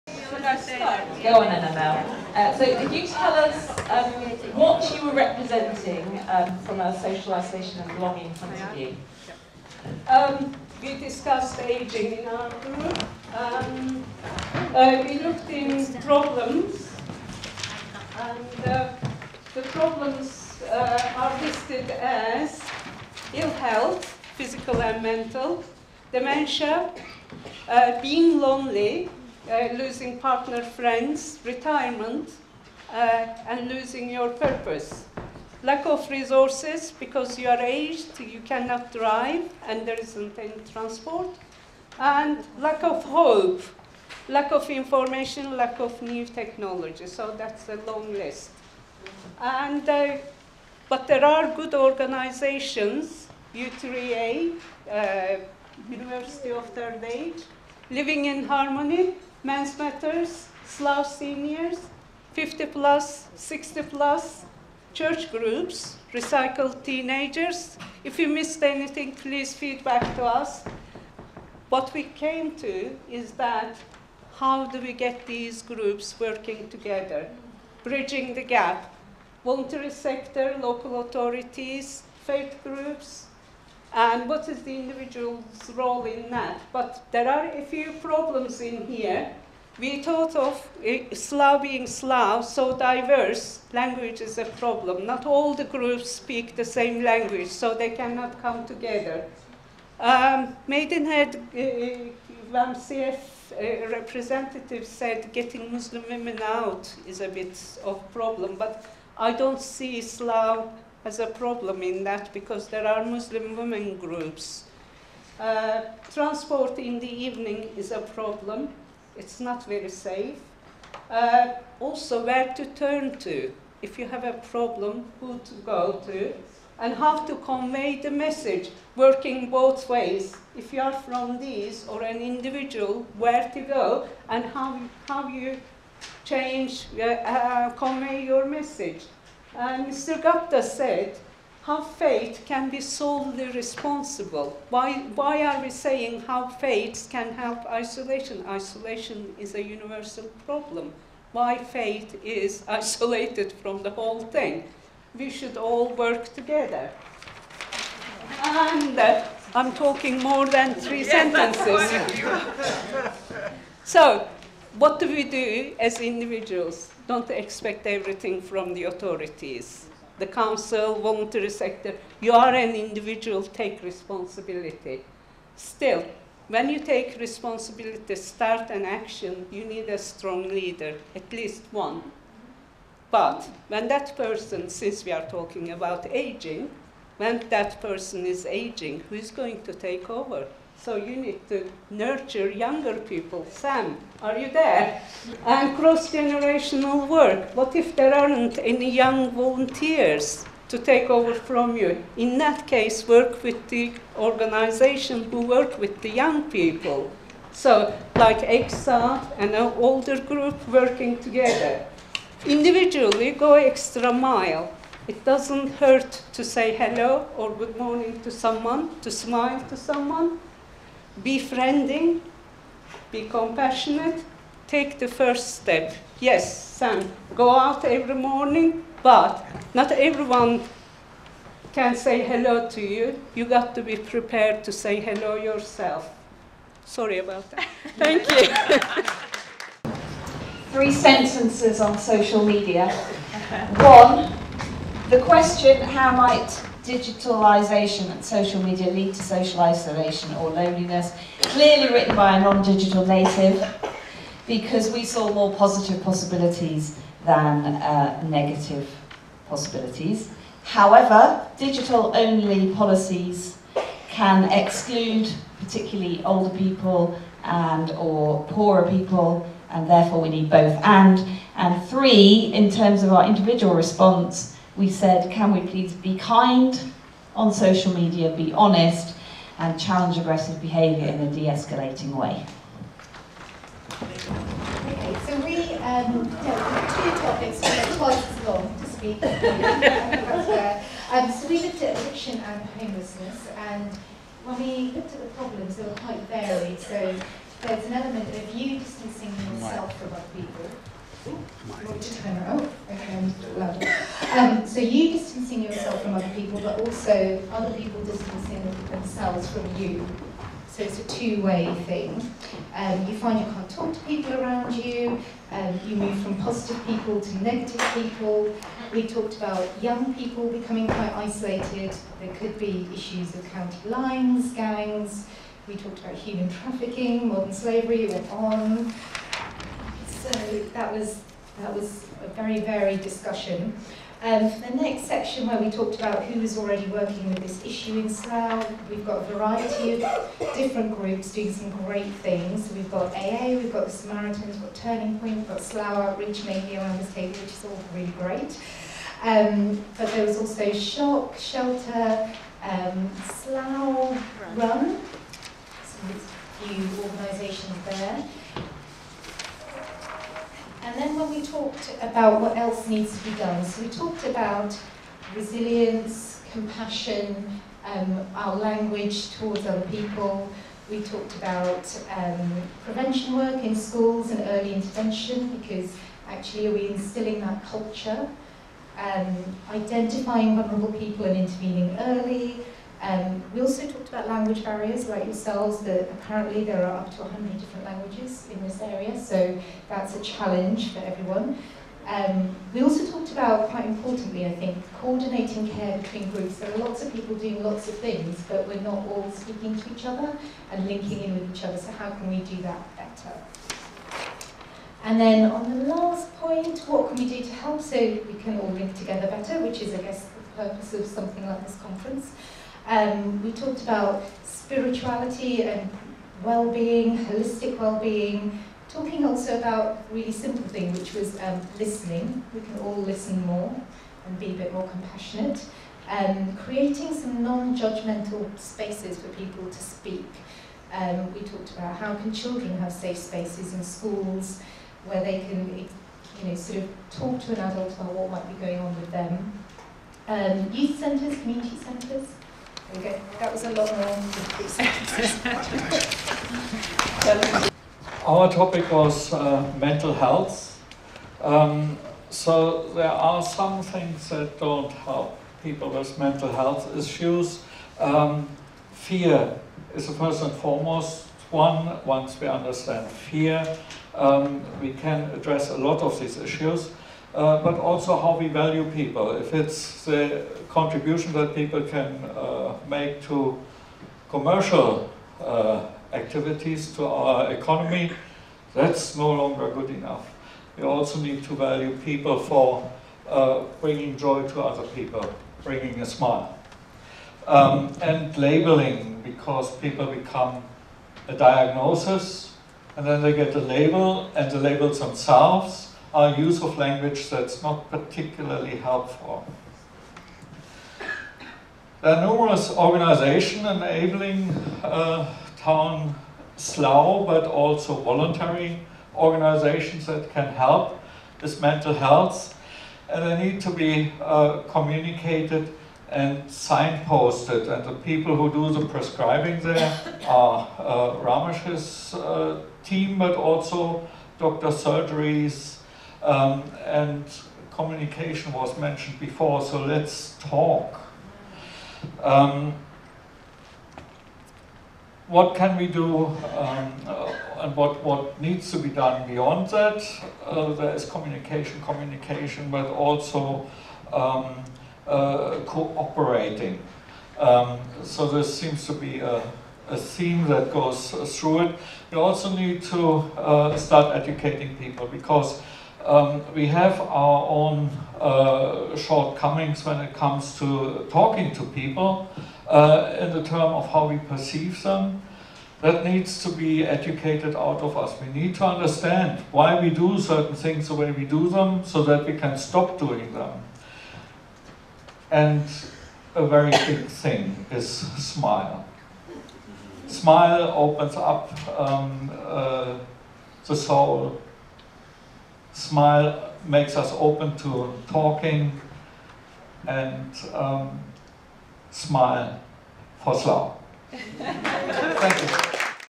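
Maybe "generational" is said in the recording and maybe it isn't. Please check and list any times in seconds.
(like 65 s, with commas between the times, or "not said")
196 s.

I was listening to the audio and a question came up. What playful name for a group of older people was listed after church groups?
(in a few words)
recycled teenagers.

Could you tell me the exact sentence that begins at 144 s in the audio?
Why, why are we saying how fate can help isolation?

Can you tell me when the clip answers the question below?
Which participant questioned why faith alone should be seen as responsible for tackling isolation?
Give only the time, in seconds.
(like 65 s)
139 s.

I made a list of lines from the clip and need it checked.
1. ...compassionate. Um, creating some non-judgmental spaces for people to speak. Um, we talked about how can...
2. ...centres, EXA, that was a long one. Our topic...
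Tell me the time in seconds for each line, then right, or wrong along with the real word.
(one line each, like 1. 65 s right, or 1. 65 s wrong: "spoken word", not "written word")
1. 424 s right
2. 441 s wrong: "Okay", not "EXA".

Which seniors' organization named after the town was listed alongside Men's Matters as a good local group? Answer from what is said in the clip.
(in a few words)
Slough Seniors.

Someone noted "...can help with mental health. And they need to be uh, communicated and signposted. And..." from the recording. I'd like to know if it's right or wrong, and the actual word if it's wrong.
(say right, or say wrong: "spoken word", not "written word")
right.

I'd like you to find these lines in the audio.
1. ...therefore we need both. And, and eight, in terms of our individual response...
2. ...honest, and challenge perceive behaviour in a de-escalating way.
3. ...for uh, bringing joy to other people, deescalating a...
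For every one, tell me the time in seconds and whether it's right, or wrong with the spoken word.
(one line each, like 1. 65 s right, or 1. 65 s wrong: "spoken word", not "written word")
1. 269 s wrong: "three", not "eight"
2. 278 s wrong: "aggressive", not "perceive"
3. 482 s wrong: "bringing", not "deescalating".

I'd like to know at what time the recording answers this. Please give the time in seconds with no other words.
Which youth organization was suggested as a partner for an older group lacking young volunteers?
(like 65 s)
208 s.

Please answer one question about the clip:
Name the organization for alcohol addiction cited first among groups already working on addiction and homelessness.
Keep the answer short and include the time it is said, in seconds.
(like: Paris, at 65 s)
AA, at 343 s.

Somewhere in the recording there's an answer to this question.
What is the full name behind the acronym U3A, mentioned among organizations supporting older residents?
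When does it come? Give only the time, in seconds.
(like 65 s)
55 s.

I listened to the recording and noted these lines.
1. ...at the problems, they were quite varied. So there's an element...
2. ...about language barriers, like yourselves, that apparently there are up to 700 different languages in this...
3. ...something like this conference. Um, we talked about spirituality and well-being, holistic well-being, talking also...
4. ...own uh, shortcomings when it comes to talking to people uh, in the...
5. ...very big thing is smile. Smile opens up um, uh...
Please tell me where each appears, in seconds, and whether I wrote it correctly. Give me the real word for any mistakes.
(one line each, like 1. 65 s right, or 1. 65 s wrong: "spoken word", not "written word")
1. 295 s right
2. 384 s wrong: "100", not "700"
3. 411 s right
4. 557 s right
5. 576 s right.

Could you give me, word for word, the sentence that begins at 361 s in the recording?
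talked about what else needs to be done.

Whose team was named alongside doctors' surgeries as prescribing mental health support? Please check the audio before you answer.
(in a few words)
Ramesh.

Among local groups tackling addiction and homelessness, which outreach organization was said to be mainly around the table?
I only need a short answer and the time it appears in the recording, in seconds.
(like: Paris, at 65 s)
Slough Outreach, at 345 s.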